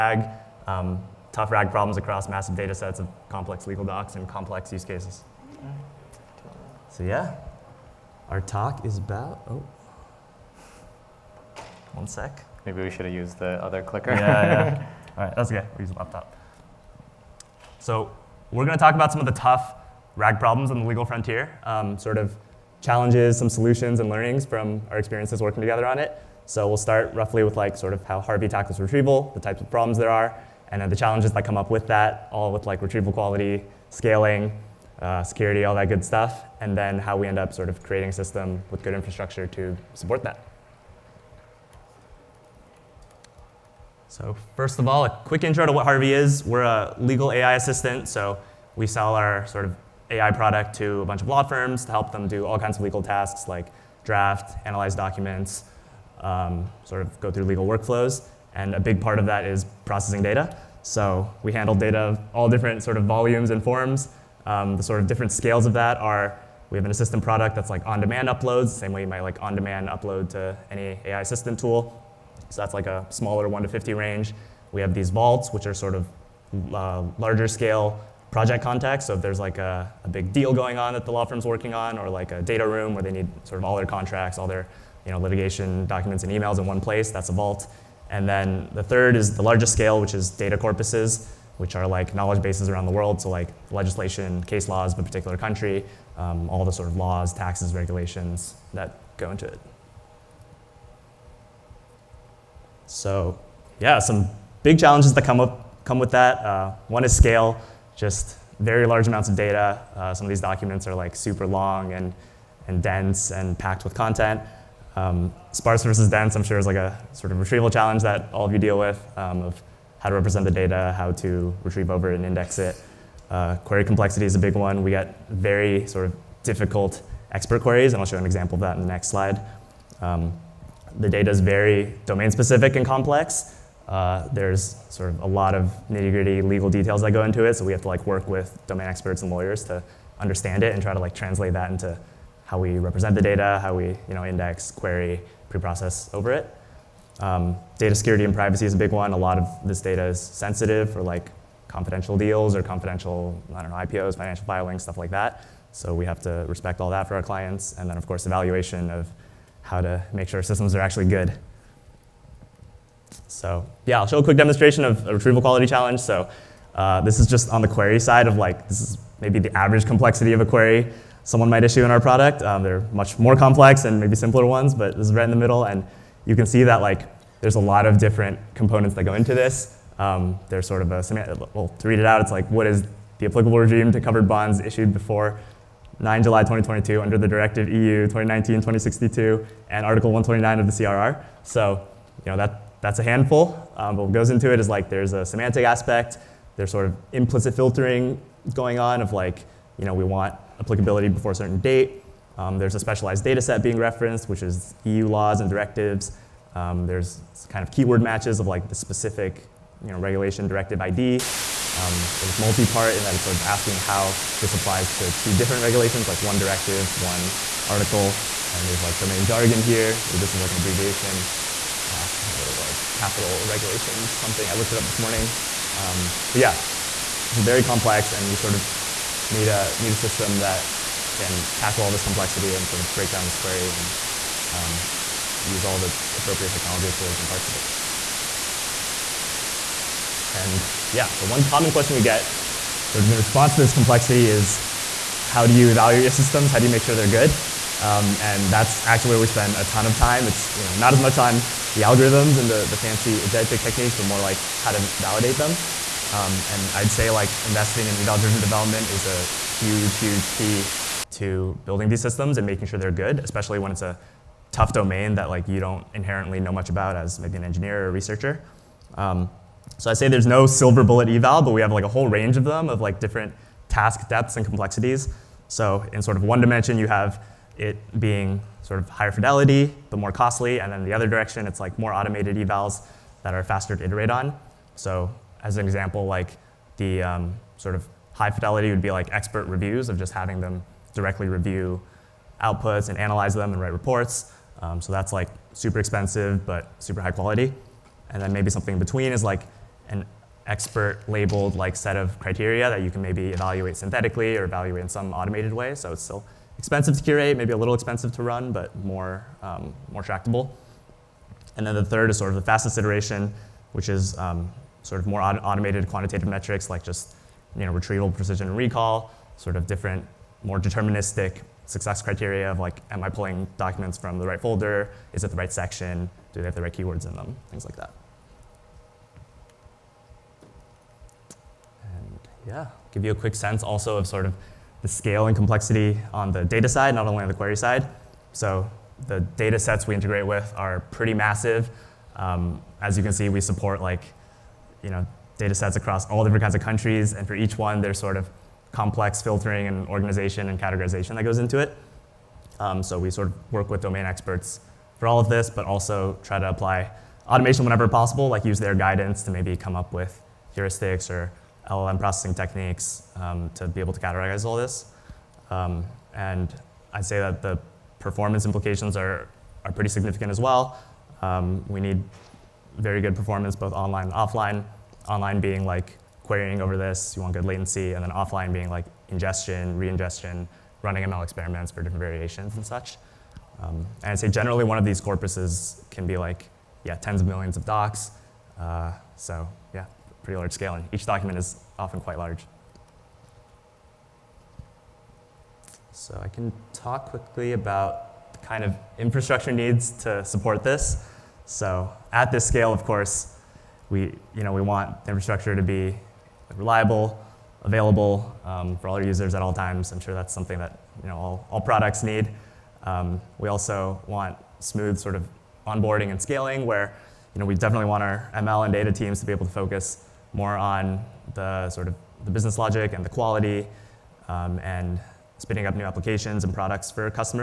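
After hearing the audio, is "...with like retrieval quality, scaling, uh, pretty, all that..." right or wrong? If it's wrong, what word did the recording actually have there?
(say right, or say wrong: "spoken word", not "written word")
wrong: "security", not "pretty".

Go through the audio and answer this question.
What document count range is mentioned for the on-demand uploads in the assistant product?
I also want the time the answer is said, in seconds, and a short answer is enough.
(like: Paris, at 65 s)
1 to 50, at 73 s.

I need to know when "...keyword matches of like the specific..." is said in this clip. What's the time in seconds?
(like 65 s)
207 s.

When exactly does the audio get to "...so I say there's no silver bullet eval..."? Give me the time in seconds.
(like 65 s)
269 s.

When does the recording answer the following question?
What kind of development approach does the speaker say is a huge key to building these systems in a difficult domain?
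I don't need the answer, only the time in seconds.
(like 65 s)
257 s.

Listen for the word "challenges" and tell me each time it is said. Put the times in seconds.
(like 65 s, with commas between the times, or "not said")
22 s, 30 s, 104 s, 117 s, 165 s.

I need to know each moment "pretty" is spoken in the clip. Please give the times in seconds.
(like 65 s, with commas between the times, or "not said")
340 s, 369 s, 390 s.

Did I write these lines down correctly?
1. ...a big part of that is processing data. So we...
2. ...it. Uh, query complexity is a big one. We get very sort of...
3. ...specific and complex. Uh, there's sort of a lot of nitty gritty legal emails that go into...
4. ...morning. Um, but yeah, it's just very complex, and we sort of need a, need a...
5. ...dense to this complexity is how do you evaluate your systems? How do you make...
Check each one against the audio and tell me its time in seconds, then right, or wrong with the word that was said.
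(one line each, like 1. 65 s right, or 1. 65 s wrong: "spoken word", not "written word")
1. 58 s right
2. 122 s right
3. 132 s wrong: "details", not "emails"
4. 224 s right
5. 243 s wrong: "response", not "dense".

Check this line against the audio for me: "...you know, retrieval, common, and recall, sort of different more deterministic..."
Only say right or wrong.
wrong.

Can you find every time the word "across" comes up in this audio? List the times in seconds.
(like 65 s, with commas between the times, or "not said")
1 s, 345 s.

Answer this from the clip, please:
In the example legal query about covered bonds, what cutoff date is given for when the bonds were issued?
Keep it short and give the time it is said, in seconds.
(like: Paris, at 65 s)
9 July 2022, at 185 s.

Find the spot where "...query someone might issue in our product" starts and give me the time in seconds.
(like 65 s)
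170 s.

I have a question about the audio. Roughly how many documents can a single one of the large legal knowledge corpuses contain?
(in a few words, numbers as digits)
tens of millions.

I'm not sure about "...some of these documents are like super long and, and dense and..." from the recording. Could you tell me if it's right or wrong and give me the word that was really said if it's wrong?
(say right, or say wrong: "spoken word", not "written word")
right.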